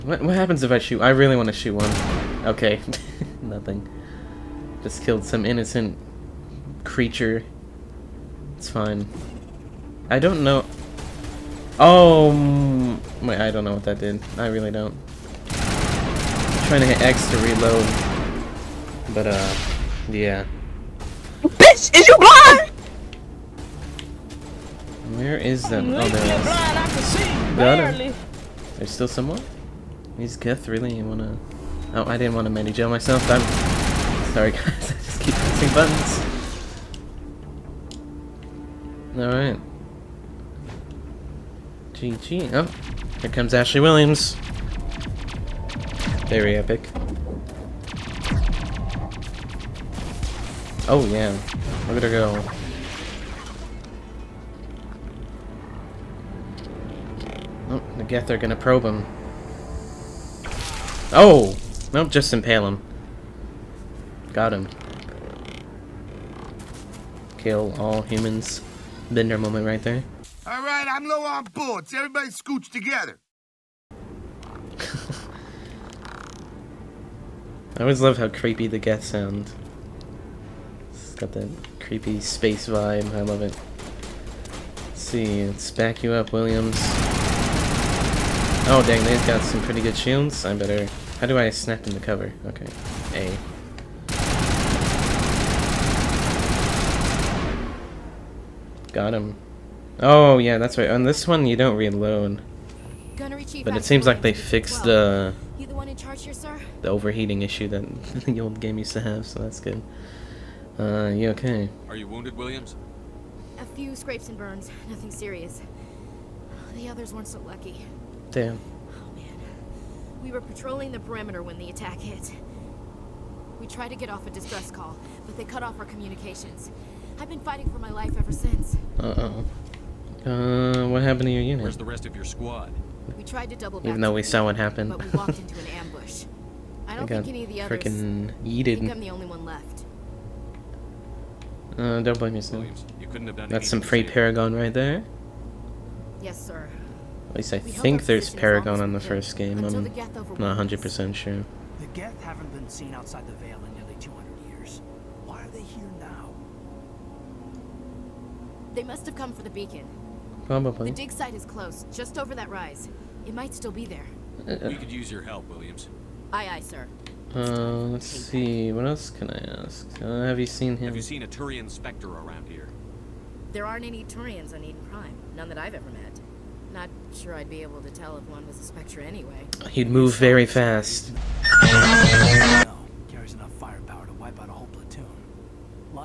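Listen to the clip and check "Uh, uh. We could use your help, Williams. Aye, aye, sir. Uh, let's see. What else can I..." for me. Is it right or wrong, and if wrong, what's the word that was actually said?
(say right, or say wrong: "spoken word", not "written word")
right.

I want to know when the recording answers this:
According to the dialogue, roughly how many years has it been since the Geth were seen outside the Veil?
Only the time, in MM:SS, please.
02:34.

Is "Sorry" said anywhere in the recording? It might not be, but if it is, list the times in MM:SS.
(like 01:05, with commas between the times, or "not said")
00:34.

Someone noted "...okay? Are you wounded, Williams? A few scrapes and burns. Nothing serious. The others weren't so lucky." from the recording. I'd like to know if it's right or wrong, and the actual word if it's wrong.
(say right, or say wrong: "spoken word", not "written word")
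right.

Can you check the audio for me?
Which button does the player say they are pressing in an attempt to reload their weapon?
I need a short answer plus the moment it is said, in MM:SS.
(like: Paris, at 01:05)
X, at 00:17.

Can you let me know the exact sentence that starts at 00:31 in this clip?
Oh, I didn't want to mini jail myself.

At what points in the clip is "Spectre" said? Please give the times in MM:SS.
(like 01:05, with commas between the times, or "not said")
02:51, 02:58.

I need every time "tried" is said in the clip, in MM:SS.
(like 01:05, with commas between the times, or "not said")
02:03, 02:13.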